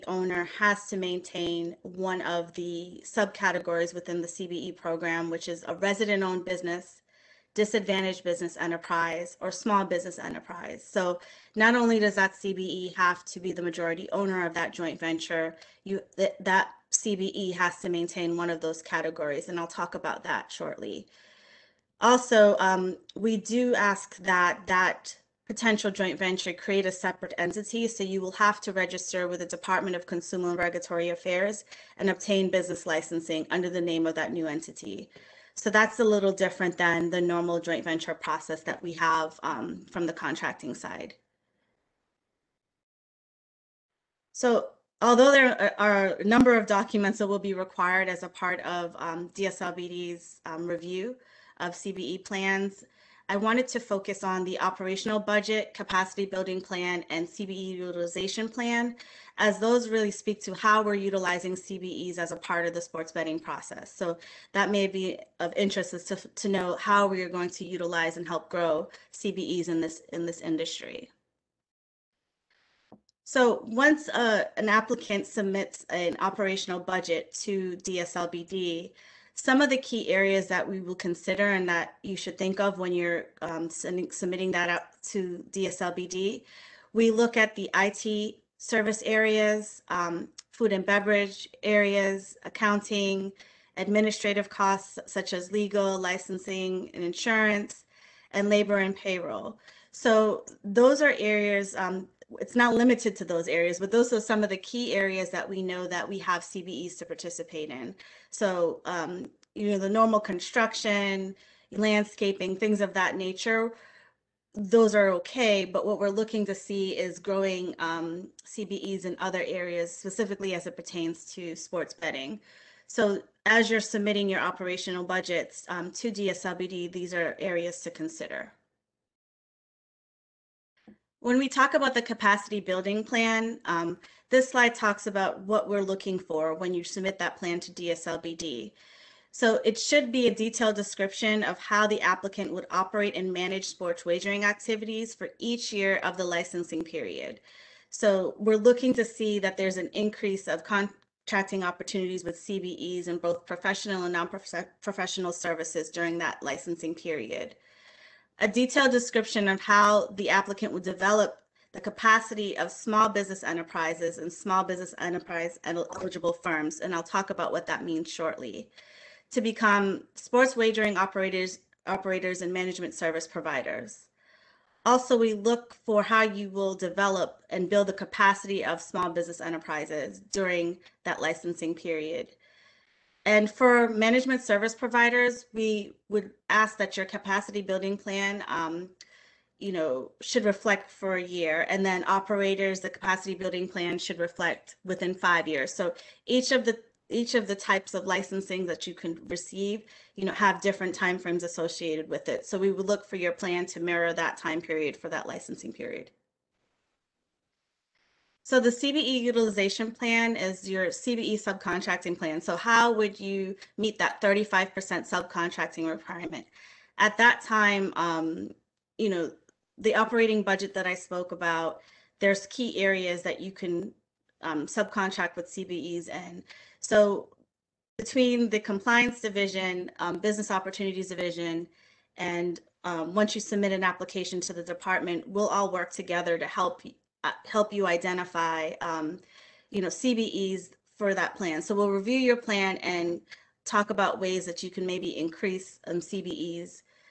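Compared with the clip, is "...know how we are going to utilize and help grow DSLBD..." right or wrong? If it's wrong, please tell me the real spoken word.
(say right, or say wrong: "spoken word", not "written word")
wrong: "CBEs", not "DSLBD".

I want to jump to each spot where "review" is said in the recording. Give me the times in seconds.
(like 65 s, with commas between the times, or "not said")
50 s, 241 s.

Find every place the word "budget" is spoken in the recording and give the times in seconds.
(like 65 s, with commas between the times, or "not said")
55 s, 76 s, 125 s, 220 s.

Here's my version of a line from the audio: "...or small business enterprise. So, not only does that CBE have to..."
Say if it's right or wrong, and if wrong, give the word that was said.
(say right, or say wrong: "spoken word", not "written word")
right.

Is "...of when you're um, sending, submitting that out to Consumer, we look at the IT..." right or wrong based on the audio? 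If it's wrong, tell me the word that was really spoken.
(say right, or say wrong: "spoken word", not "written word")
wrong: "DSLBD", not "Consumer".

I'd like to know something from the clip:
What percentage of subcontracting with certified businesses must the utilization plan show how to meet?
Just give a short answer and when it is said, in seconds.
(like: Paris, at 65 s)
35%, at 214 s.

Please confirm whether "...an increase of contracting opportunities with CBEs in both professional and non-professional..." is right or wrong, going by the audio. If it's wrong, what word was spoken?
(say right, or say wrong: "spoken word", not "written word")
right.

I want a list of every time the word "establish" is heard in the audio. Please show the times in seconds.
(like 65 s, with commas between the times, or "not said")
not said.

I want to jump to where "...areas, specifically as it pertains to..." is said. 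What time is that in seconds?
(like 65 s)
119 s.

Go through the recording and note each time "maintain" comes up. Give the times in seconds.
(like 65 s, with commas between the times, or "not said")
0 s, 17 s.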